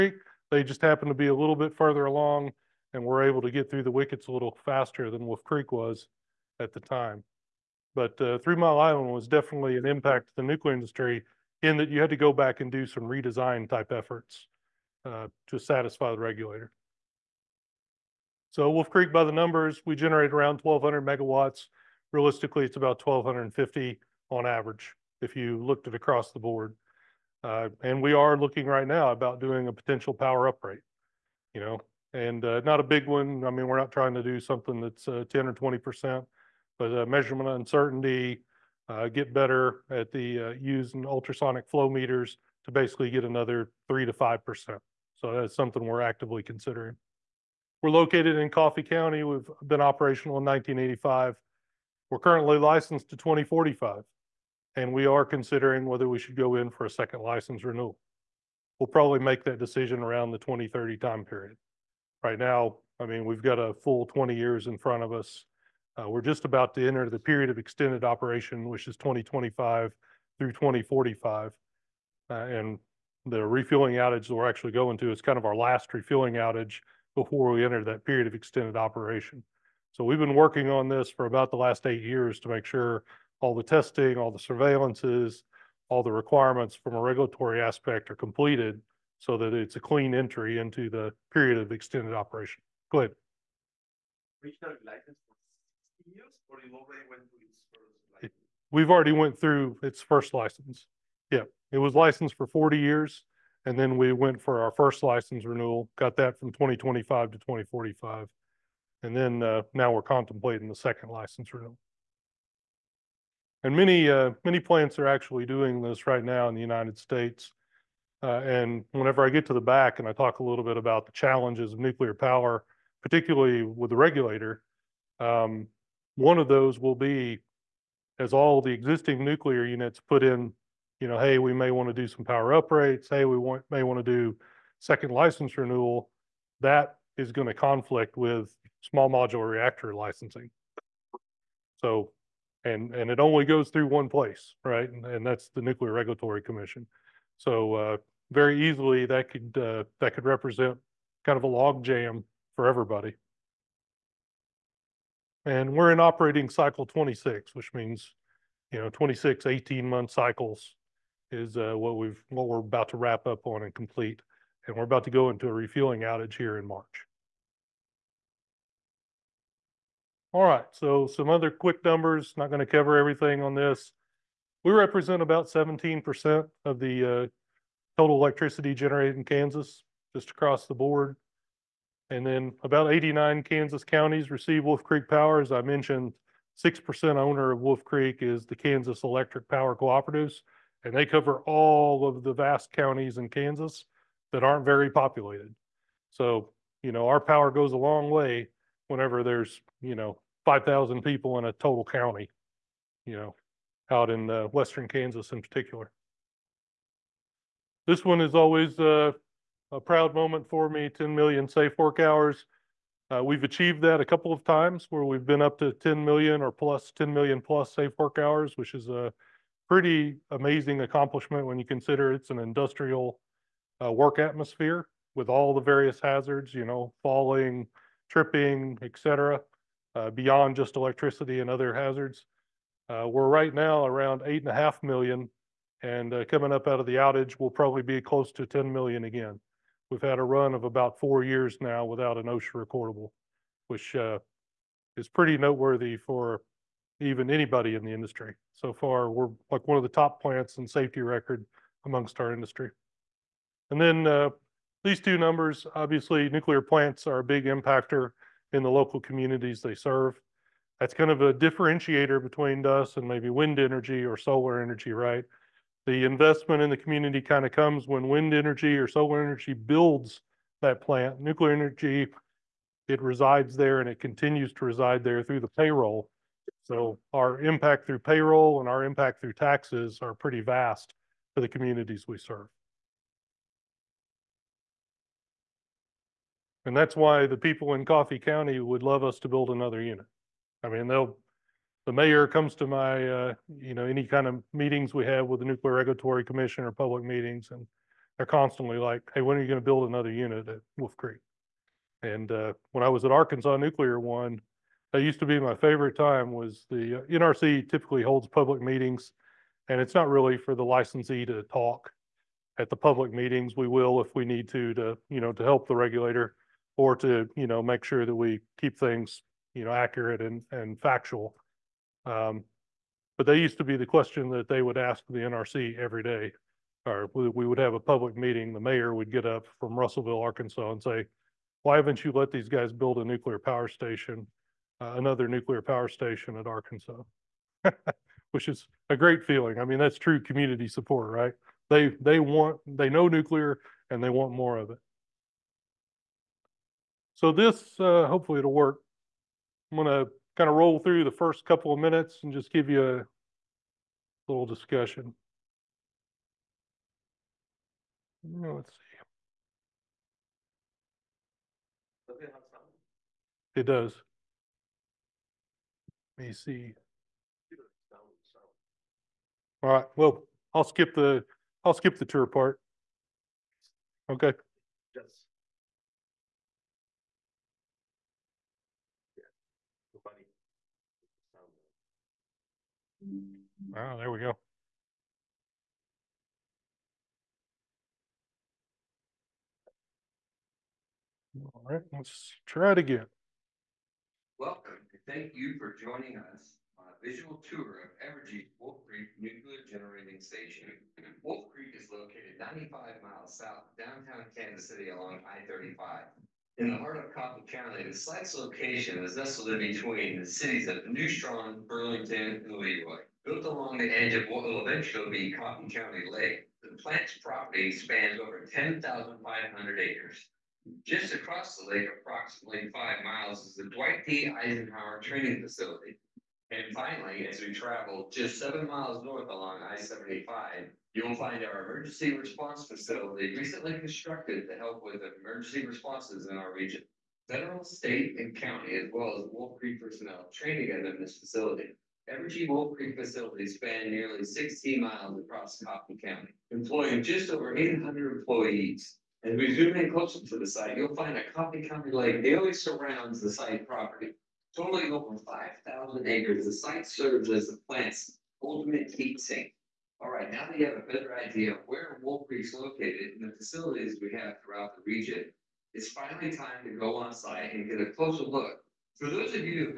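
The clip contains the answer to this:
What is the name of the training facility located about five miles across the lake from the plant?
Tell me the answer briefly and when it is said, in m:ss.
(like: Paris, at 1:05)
Dwight D. Eisenhower Training Facility, at 7:03.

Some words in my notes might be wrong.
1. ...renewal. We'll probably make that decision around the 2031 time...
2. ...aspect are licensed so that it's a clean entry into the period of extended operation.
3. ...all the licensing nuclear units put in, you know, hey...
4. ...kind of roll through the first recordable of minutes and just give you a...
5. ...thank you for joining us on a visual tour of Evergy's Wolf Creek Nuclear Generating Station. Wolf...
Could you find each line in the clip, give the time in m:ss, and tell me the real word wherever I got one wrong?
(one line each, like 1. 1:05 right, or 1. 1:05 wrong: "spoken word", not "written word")
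1. 0:57 wrong: "2030", not "2031"
2. 1:27 wrong: "completed", not "licensed"
3. 2:08 wrong: "existing", not "licensing"
4. 5:50 wrong: "couple", not "recordable"
5. 6:35 right.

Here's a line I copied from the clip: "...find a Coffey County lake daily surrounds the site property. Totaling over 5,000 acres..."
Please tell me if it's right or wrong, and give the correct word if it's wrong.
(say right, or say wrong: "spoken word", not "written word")
right.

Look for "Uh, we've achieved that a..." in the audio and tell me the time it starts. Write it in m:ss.
3:33.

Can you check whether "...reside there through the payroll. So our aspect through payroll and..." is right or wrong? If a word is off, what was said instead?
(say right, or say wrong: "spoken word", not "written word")
wrong: "impact", not "aspect".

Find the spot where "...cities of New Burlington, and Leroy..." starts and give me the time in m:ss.
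6:50.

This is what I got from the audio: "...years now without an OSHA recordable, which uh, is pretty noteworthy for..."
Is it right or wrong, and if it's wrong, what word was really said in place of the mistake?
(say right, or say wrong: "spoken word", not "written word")
right.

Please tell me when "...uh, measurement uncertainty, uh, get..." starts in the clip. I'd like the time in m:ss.
0:36.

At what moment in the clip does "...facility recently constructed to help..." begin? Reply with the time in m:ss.
7:12.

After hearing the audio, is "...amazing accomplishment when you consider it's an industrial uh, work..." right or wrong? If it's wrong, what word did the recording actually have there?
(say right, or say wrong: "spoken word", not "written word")
right.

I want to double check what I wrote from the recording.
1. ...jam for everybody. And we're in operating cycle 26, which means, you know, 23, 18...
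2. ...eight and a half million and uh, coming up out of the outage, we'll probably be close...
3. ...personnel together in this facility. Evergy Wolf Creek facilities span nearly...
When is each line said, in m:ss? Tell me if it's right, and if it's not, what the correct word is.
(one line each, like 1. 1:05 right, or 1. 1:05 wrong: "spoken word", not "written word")
1. 2:31 wrong: "26", not "23"
2. 3:54 right
3. 7:19 right.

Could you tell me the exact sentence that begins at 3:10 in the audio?
And they cover all of the vast counties in Kansas that aren't very populated.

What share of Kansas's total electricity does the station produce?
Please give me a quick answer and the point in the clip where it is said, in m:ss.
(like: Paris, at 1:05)
17%, at 2:55.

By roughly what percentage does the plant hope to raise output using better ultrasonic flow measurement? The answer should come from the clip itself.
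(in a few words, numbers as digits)
3 to 5%.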